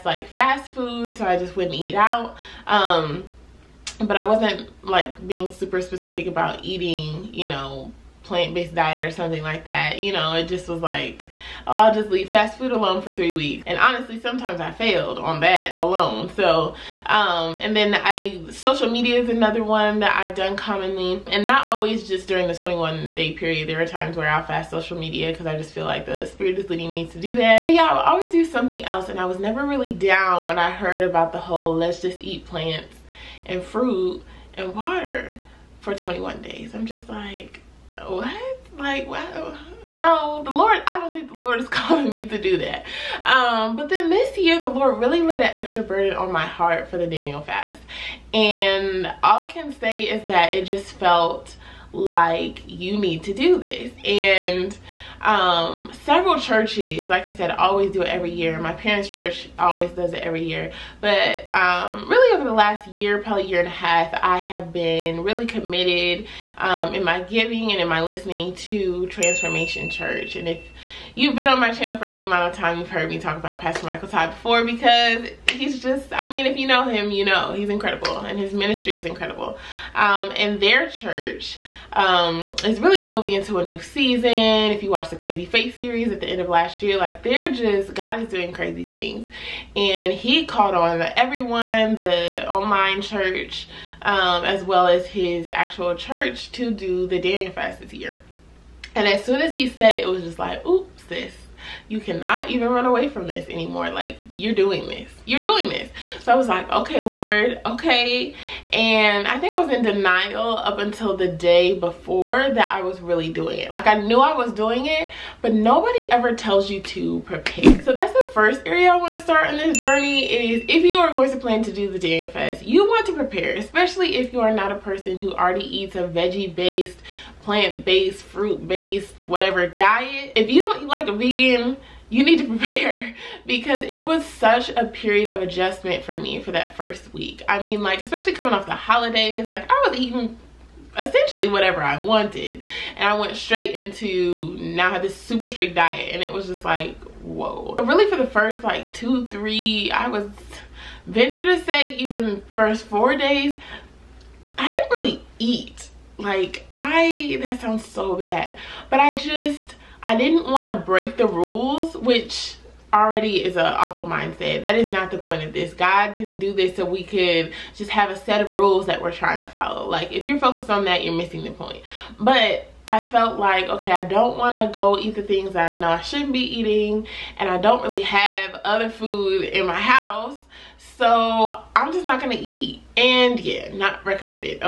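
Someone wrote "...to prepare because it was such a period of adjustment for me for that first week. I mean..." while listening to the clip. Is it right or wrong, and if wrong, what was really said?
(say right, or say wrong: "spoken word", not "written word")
right.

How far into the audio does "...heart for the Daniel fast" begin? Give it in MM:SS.
00:46.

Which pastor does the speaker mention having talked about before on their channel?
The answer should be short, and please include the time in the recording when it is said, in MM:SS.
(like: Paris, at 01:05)
Michael Todd, at 01:13.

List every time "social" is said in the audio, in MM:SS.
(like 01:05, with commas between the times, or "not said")
00:18, 00:24.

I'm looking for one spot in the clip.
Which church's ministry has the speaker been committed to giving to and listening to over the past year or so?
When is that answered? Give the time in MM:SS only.
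01:09.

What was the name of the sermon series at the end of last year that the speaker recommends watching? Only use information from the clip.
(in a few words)
Crazy Faith.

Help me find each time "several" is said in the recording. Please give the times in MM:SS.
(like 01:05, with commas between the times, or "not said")
00:56.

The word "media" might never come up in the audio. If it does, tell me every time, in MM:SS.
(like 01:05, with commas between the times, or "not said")
00:18, 00:24.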